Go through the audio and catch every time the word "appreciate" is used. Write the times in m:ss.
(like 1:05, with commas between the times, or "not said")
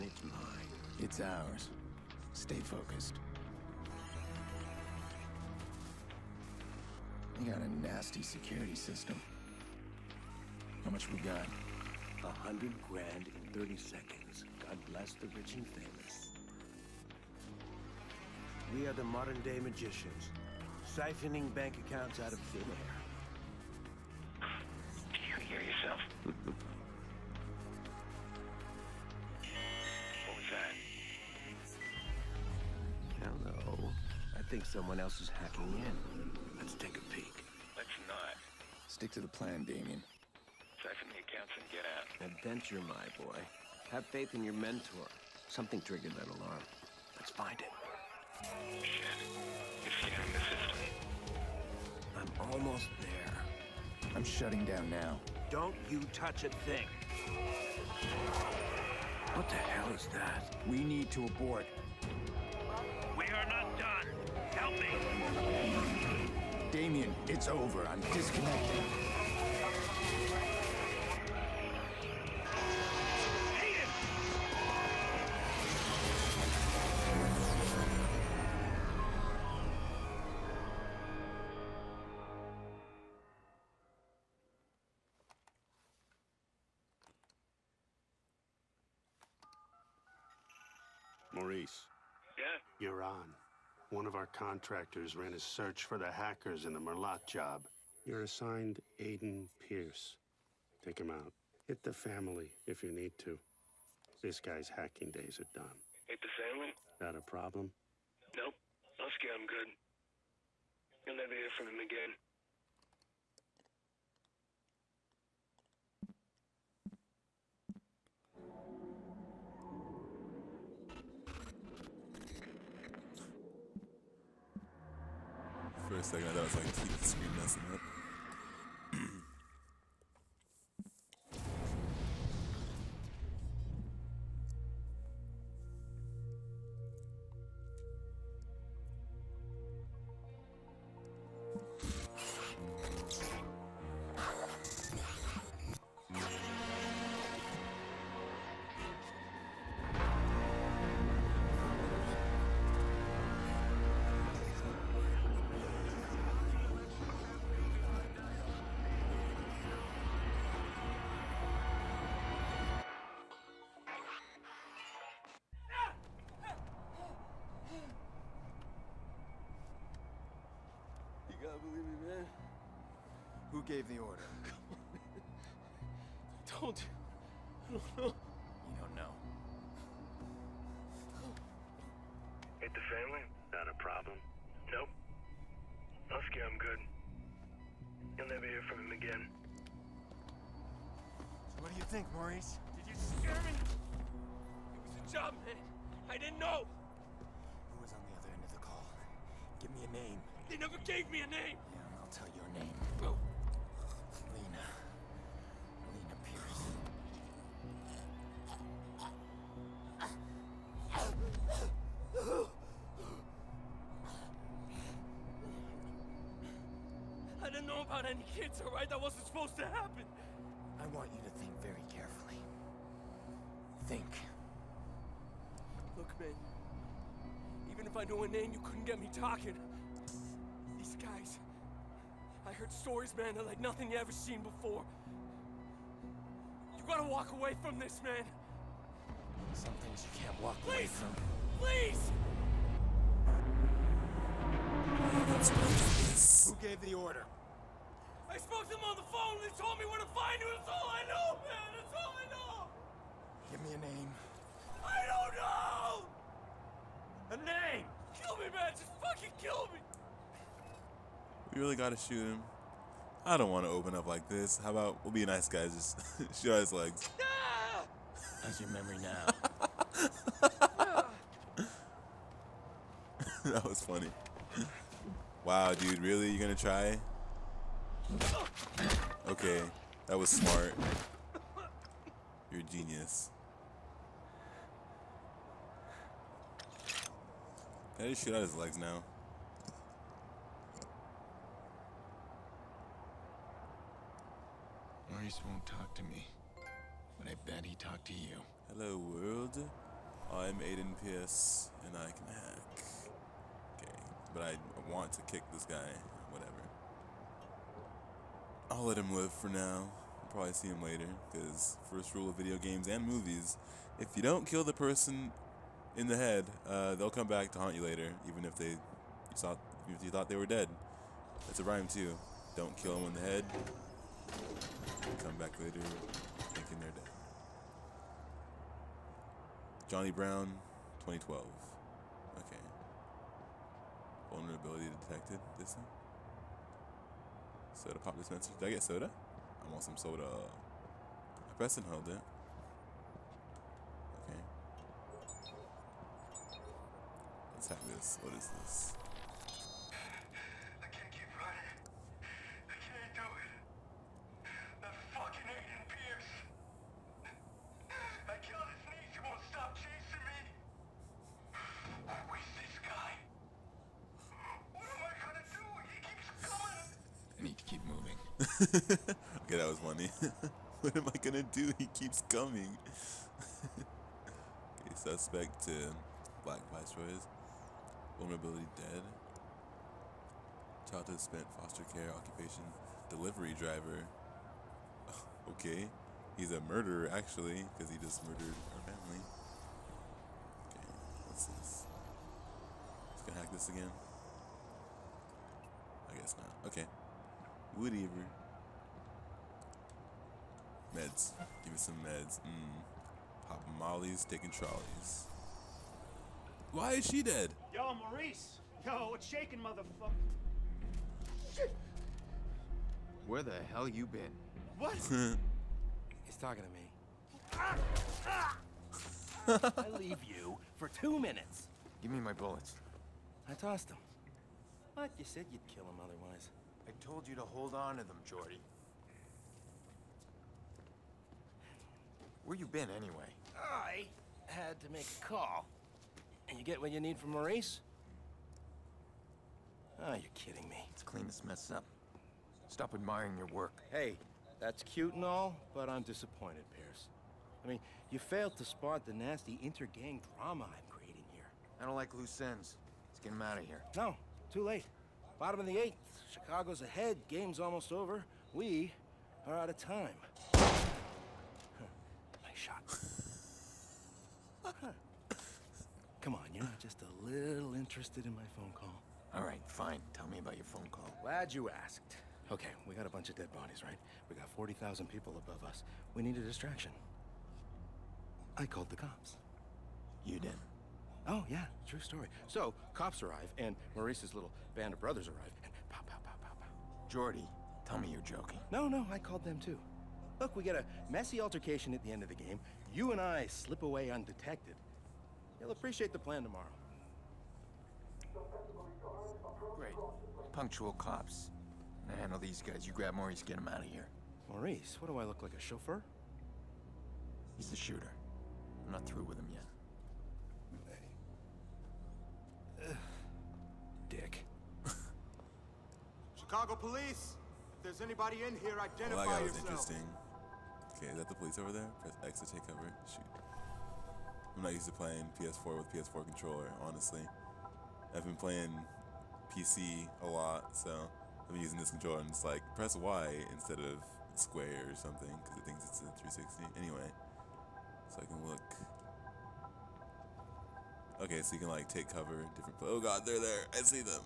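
8:15.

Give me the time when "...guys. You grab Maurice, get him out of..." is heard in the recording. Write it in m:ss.
8:22.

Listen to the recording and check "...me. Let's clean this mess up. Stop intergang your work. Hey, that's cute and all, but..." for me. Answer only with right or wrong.
wrong.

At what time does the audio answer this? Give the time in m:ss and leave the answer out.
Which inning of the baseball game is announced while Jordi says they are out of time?
7:35.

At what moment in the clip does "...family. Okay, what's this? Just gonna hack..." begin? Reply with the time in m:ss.
6:28.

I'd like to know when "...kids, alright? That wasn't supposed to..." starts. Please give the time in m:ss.
3:38.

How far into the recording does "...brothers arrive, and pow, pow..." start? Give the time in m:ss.
8:04.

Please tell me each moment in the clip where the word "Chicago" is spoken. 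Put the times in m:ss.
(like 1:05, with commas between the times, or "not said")
7:36, 8:36.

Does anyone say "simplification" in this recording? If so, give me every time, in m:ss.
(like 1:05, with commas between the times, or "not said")
not said.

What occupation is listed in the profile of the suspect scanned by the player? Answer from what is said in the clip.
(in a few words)
Delivery driver.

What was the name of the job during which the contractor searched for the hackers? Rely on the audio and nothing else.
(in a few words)
Merlaut.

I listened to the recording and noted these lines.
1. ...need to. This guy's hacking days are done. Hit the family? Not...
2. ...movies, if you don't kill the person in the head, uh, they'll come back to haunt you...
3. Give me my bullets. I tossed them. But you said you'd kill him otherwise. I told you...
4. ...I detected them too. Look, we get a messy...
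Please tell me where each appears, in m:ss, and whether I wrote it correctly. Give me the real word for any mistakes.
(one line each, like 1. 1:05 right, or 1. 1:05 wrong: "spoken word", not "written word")
1. 1:42 right
2. 5:13 right
3. 7:02 right
4. 8:09 wrong: "called", not "detected".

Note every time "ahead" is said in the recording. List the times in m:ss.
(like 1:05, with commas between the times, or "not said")
7:36.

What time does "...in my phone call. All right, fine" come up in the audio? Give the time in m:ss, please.
7:48.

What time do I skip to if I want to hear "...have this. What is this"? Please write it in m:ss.
5:47.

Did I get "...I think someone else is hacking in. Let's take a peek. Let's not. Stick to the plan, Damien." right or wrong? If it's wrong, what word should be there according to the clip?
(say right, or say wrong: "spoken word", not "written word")
right.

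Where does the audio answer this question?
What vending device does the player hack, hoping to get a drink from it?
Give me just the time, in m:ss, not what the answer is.
5:37.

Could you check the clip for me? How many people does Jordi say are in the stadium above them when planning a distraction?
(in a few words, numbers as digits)
40,000.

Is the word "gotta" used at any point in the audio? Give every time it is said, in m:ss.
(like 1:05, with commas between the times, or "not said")
3:56, 4:21.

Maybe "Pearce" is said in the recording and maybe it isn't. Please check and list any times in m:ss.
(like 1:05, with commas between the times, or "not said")
1:39, 5:01, 7:26.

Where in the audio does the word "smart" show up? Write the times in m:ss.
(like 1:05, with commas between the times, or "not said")
4:40.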